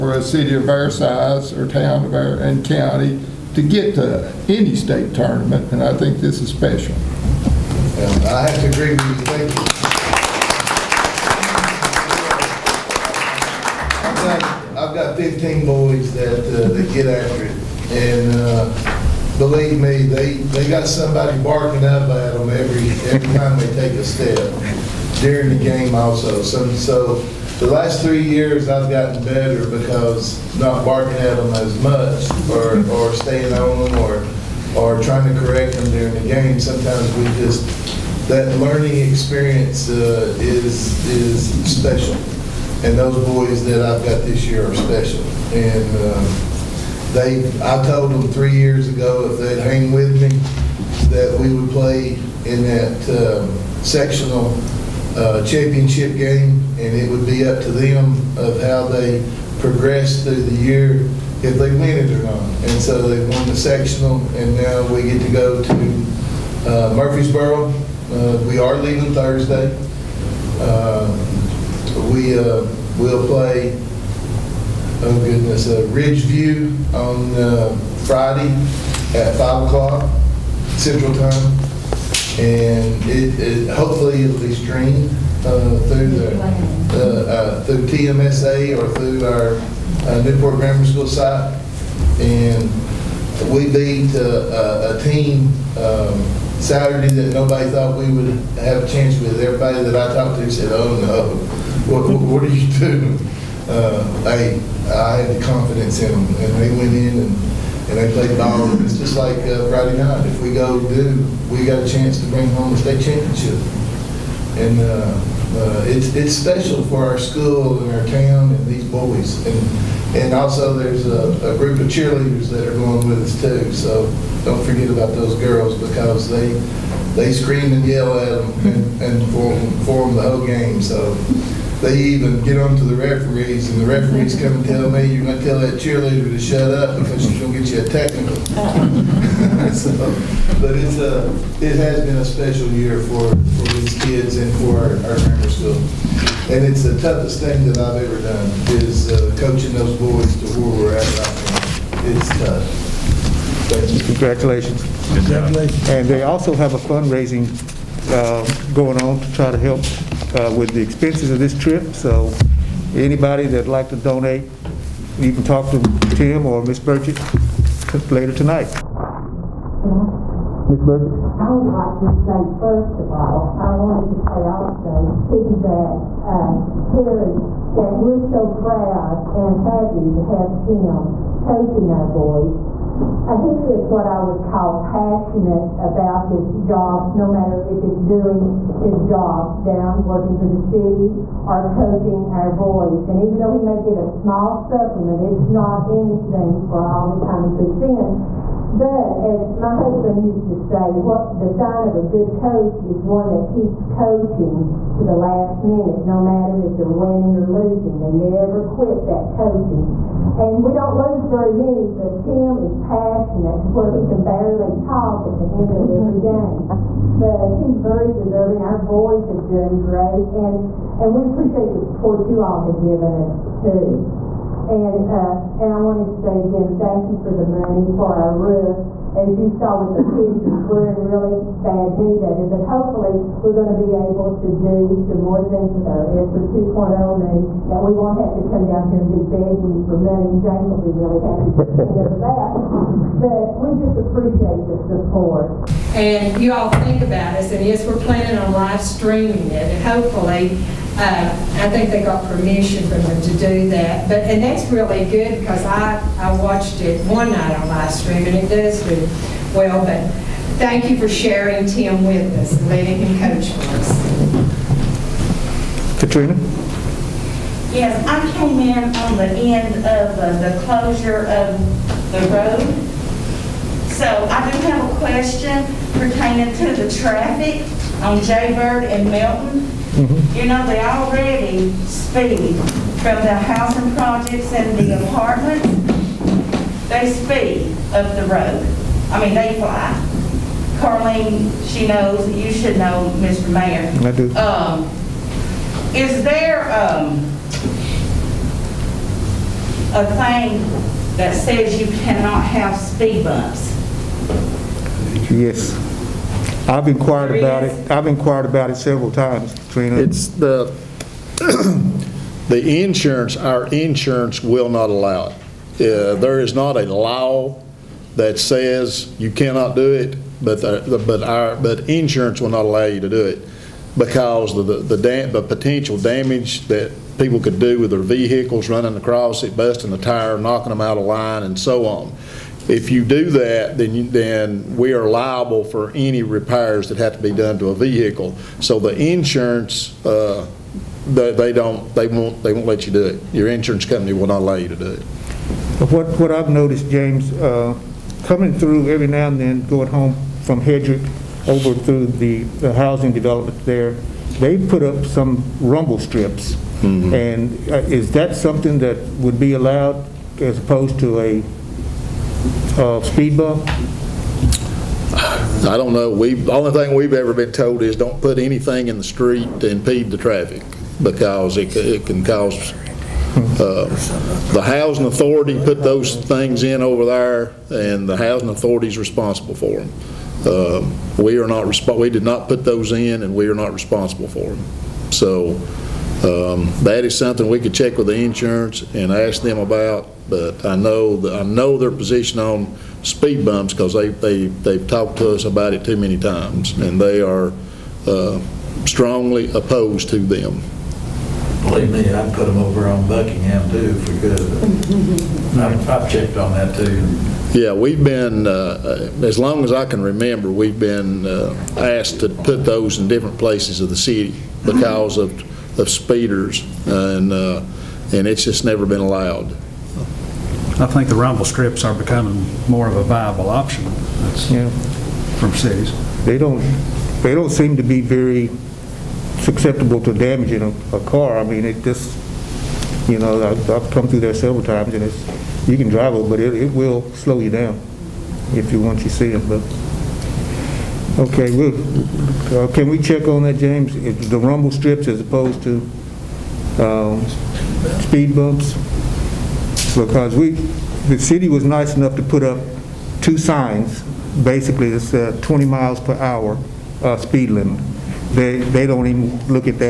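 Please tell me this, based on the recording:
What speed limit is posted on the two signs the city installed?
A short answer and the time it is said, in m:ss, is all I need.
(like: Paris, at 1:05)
20 miles per hour, at 7:35.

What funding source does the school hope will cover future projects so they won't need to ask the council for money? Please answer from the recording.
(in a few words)
ESSER 2.0.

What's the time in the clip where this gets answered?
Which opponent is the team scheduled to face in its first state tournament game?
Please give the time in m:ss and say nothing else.
1:15.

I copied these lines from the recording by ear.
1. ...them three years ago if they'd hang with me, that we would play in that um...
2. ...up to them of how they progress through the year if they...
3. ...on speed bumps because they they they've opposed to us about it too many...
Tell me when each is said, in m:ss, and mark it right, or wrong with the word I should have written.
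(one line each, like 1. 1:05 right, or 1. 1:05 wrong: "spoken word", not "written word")
1. 0:48 right
2. 0:57 right
3. 6:32 wrong: "talked", not "opposed".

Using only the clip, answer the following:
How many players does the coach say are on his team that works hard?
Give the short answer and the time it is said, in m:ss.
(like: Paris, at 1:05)
15, at 0:15.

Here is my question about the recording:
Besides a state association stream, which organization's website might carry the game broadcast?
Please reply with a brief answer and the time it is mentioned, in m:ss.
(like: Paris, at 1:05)
Newport Grammar School, at 1:30.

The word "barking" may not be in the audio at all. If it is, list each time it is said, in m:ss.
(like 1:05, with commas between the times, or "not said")
0:21, 0:30.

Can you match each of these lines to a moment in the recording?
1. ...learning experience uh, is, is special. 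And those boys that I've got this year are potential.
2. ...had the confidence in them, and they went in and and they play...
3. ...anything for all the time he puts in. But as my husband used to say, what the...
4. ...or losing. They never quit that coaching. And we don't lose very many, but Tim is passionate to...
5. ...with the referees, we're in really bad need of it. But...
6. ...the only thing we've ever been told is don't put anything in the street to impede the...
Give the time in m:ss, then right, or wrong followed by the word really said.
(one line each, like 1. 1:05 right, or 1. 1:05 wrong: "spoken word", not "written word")
1. 0:38 wrong: "special", not "potential"
2. 1:45 right
3. 3:15 right
4. 3:27 right
5. 3:49 wrong: "pictures", not "referees"
6. 6:06 right.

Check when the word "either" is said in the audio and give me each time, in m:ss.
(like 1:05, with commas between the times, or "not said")
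not said.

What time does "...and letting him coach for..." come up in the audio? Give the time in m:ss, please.
4:22.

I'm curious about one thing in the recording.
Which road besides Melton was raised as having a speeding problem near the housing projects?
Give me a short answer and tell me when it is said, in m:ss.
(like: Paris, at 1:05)
Jaybird, at 4:38.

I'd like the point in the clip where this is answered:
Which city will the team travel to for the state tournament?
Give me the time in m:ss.
1:06.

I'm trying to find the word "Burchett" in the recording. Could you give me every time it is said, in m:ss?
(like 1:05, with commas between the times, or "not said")
2:46, 2:50.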